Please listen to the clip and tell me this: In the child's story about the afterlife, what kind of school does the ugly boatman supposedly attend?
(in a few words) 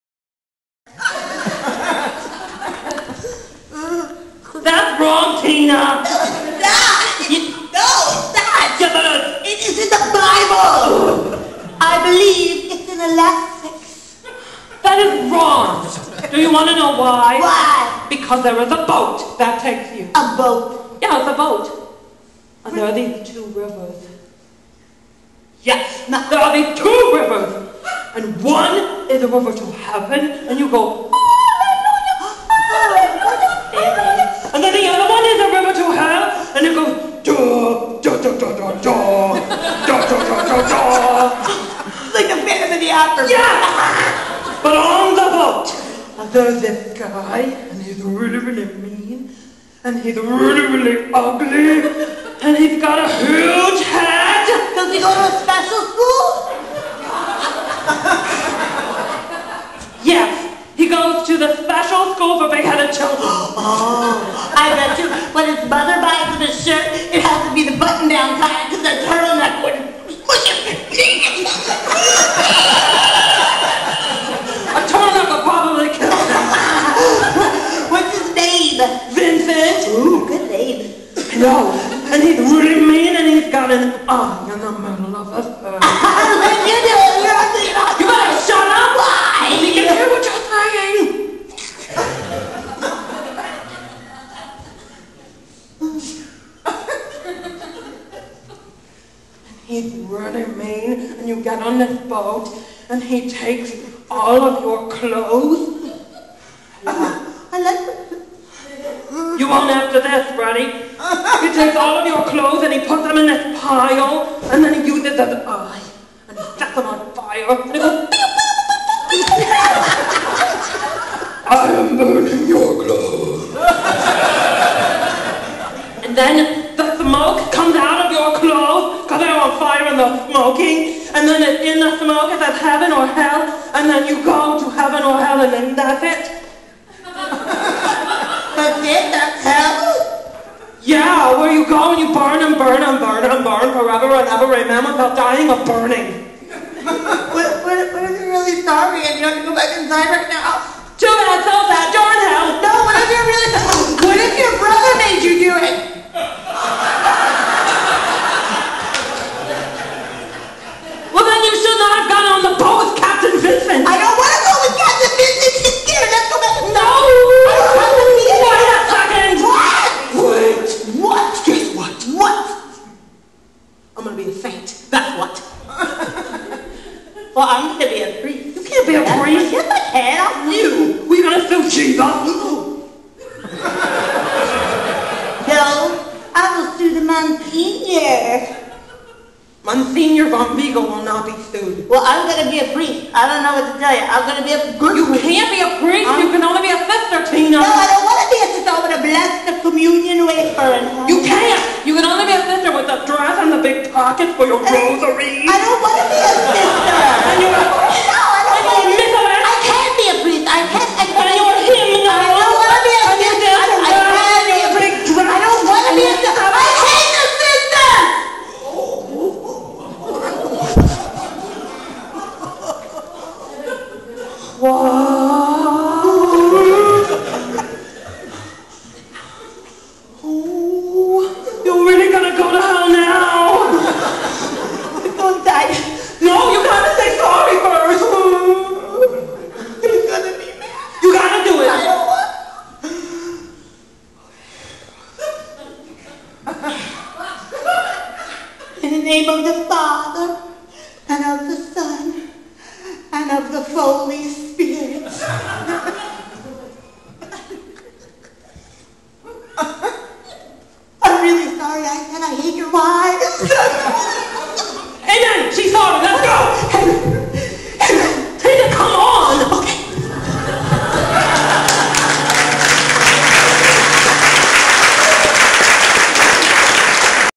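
Special school for big-headed children.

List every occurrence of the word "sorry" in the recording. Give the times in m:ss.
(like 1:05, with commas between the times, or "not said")
2:28, 4:21.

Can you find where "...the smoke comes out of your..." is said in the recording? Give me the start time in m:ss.
2:06.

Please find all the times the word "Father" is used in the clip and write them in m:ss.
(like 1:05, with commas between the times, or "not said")
4:09.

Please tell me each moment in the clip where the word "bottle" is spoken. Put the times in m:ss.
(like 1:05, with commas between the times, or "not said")
not said.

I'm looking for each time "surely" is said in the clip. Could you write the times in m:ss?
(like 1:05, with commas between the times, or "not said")
not said.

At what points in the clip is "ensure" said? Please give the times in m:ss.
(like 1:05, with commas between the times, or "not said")
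not said.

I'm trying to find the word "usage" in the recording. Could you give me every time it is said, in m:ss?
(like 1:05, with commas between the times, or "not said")
not said.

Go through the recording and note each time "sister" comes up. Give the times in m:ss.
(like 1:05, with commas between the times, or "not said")
3:16, 3:22, 3:27.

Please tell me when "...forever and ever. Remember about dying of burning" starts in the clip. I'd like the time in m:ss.
2:23.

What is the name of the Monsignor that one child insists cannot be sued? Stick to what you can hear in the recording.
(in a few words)
Monsignor von Vigo.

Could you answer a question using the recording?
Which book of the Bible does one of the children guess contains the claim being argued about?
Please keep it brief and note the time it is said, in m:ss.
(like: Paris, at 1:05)
Ecclesiastes, at 0:13.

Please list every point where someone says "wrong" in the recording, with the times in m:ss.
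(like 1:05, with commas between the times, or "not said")
0:15.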